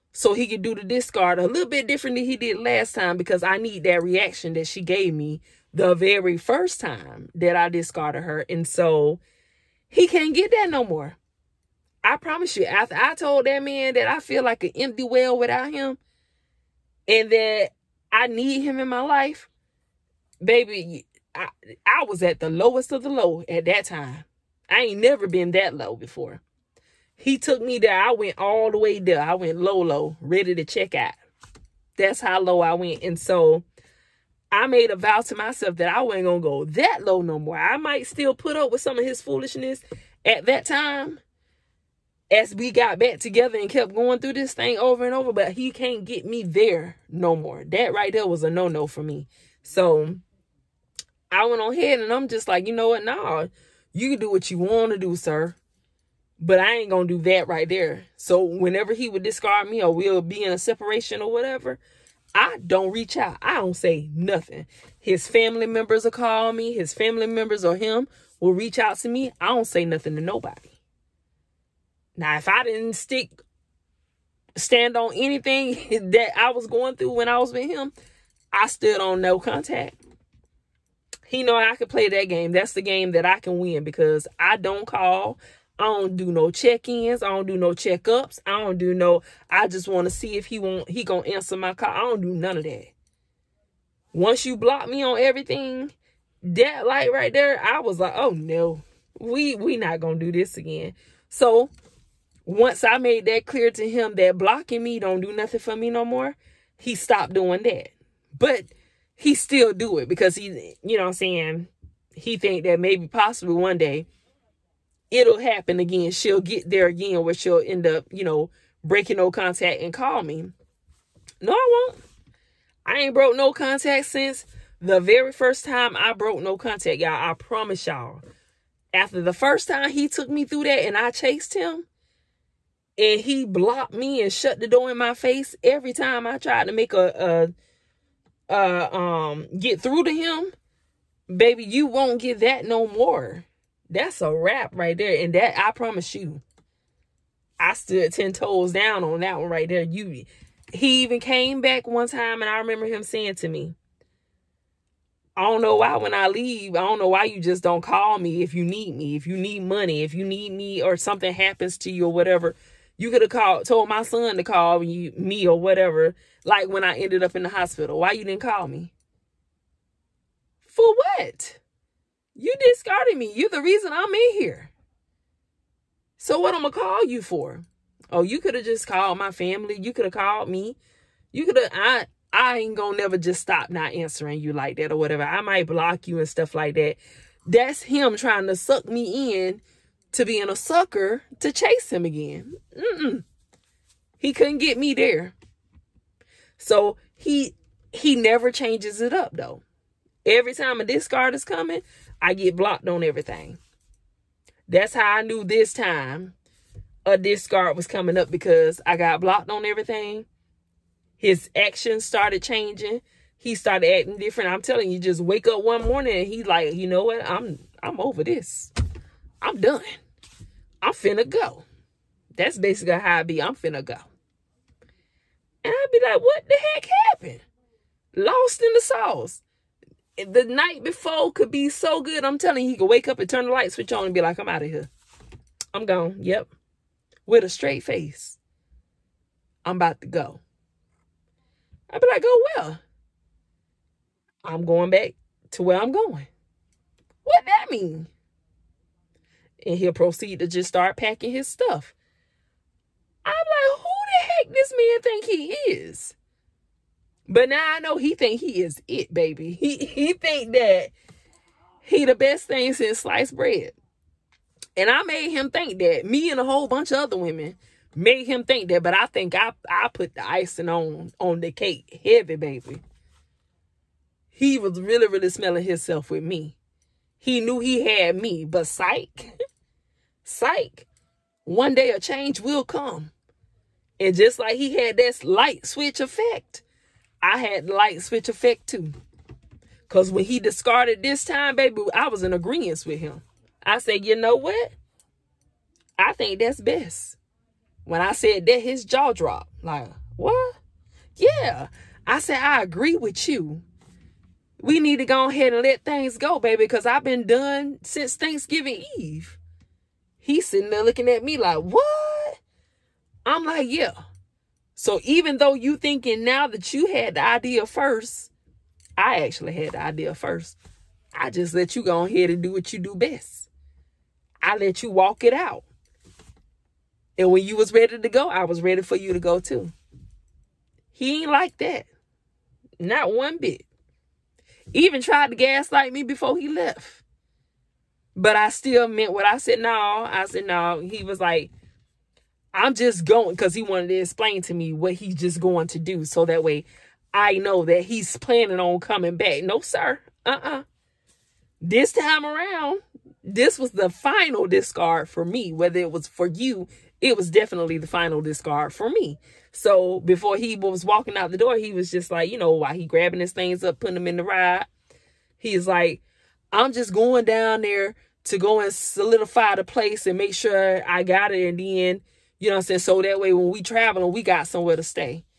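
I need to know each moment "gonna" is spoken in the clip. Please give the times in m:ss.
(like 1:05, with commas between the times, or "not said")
1:31, 1:40, 3:02.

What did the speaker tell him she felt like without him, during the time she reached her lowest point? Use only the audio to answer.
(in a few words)
An empty well.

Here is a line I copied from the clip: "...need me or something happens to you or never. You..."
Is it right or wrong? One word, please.
wrong.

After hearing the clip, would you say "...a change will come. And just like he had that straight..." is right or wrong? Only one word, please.
wrong.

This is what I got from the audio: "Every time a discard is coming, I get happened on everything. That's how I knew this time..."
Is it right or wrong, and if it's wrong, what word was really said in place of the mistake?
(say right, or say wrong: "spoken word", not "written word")
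wrong: "blocked", not "happened".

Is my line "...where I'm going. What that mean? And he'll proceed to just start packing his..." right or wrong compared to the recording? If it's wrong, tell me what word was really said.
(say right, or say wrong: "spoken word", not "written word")
right.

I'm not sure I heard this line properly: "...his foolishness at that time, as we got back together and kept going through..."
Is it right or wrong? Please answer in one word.
right.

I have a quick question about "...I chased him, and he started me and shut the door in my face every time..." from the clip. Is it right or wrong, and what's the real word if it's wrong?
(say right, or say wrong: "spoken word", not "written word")
wrong: "blocked", not "started".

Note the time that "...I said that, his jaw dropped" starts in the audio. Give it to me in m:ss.
4:57.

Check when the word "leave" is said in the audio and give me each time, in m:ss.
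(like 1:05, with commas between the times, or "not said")
2:36.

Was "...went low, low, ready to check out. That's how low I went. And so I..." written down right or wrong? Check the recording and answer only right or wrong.
right.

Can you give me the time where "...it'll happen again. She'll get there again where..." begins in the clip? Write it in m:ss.
1:55.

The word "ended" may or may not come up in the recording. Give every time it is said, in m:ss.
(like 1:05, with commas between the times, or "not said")
2:46.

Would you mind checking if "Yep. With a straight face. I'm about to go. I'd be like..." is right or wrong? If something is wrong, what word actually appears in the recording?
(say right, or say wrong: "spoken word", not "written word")
right.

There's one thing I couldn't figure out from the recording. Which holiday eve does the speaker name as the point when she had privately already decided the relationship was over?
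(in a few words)
Thanksgiving Eve.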